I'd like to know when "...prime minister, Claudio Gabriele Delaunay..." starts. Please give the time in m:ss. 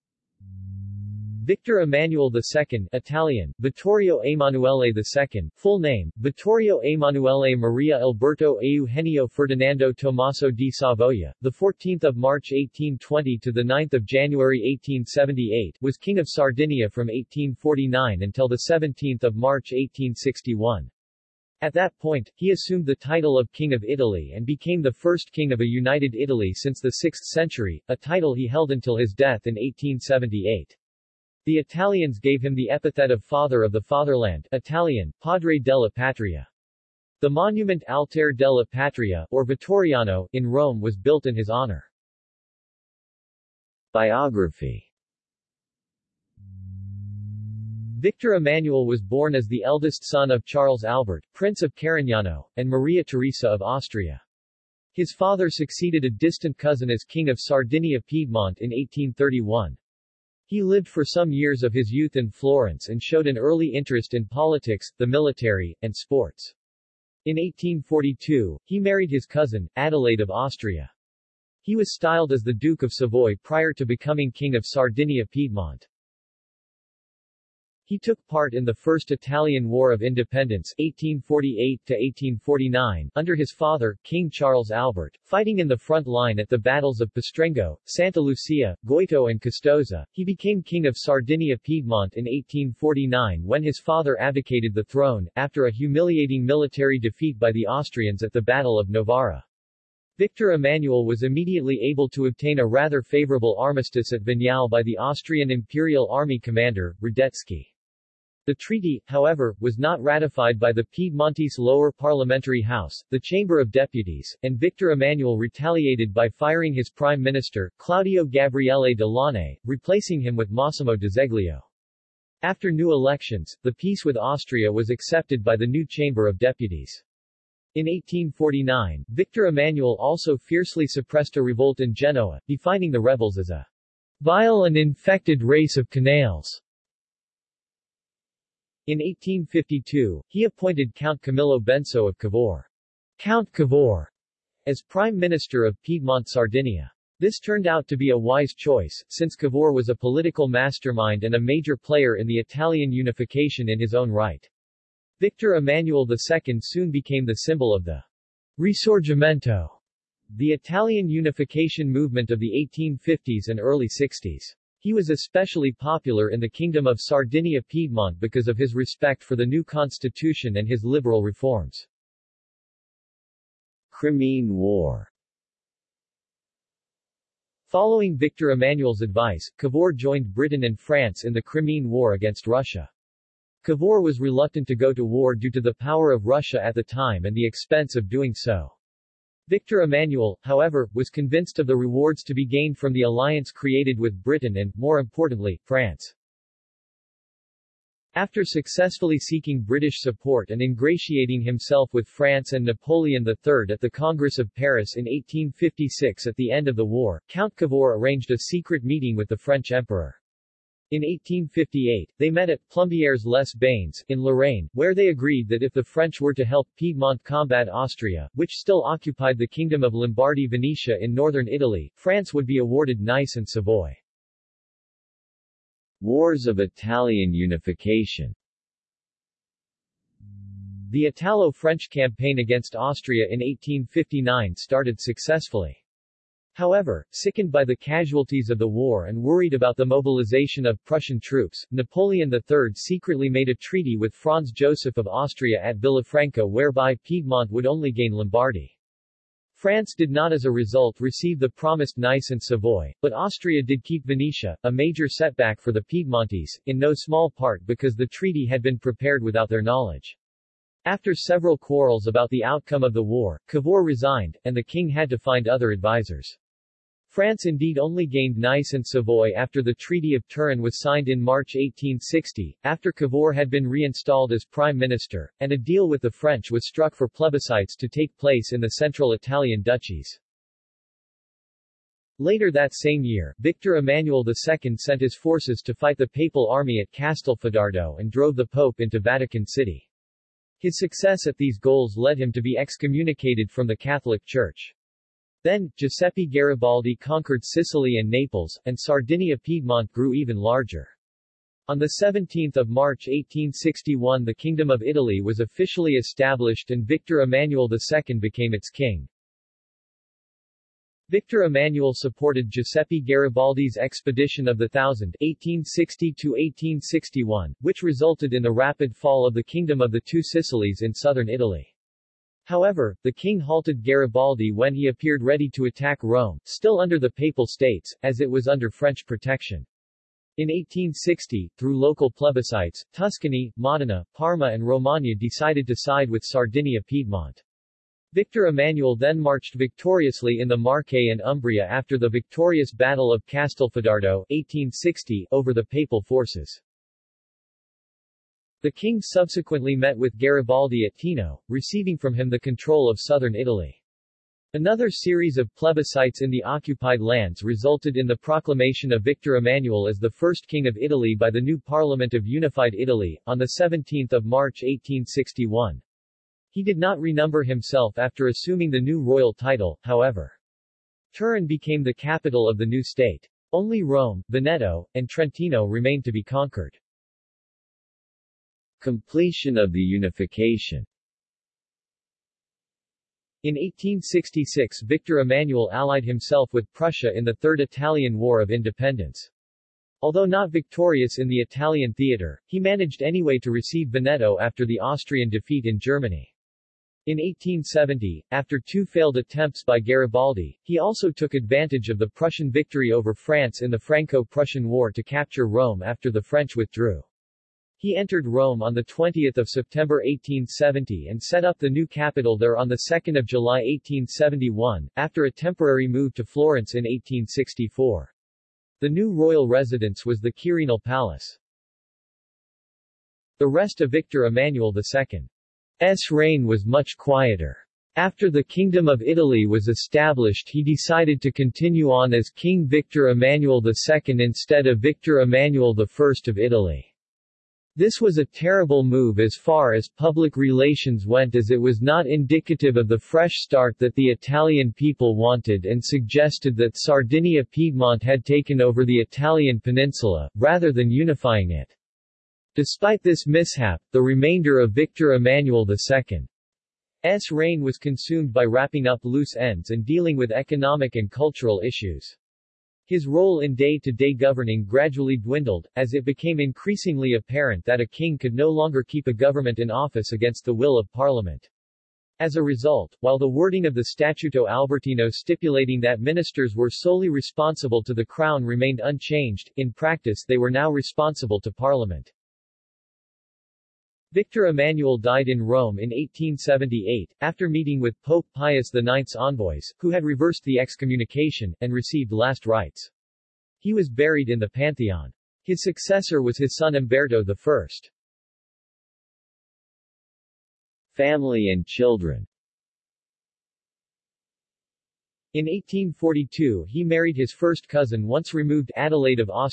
1:56.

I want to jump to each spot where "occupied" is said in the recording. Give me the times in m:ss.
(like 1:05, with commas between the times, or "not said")
3:38, 5:56.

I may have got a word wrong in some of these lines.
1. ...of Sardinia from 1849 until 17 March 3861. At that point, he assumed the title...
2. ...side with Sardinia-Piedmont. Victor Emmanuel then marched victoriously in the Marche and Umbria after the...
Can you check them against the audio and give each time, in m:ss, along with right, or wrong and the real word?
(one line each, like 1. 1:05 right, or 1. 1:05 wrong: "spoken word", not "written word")
1. 0:16 wrong: "1861", not "3861"
2. 5:35 right.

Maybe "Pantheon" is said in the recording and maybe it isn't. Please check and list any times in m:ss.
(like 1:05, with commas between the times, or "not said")
8:14.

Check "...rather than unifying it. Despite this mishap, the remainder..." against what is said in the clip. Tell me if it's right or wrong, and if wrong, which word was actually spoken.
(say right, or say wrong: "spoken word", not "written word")
right.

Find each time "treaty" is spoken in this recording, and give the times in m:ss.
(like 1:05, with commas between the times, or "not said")
1:48, 4:03, 4:18, 4:29.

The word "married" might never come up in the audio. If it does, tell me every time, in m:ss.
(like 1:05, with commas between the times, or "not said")
1:08, 8:26.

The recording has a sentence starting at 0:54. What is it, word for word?
His father succeeded a distant cousin as King of Sardinia Piedmont in 1831.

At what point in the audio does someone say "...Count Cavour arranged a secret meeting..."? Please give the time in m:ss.
3:27.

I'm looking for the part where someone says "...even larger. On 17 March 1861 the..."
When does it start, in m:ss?
5:00.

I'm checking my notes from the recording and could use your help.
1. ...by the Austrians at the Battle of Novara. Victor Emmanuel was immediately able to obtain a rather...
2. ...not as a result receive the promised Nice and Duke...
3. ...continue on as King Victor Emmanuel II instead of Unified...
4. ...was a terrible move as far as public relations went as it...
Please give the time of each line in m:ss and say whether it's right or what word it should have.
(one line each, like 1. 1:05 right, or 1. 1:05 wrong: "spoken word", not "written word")
1. 1:37 right
2. 4:10 wrong: "Savoy", not "Duke"
3. 7:11 wrong: "Victor", not "Unified"
4. 7:18 right.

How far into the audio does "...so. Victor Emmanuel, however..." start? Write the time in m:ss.
3:08.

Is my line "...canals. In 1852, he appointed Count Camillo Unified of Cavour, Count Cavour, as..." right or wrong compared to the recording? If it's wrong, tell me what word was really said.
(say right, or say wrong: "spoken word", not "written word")
wrong: "Benso", not "Unified".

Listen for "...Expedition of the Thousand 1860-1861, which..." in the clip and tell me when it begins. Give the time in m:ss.
5:13.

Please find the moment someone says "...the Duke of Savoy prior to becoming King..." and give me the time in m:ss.
1:12.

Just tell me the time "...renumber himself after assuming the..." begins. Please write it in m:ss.
6:06.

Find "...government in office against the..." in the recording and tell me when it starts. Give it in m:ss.
7:49.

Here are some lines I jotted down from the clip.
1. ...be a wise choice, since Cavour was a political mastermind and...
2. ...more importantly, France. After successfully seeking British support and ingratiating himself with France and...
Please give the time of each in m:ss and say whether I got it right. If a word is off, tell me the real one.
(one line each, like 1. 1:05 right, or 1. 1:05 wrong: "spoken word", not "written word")
1. 2:27 right
2. 3:14 right.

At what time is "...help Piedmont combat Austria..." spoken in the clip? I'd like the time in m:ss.
3:36.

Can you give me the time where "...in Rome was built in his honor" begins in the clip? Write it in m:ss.
0:40.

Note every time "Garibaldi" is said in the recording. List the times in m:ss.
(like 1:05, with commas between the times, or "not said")
4:56, 5:12, 5:23, 5:50, 6:39.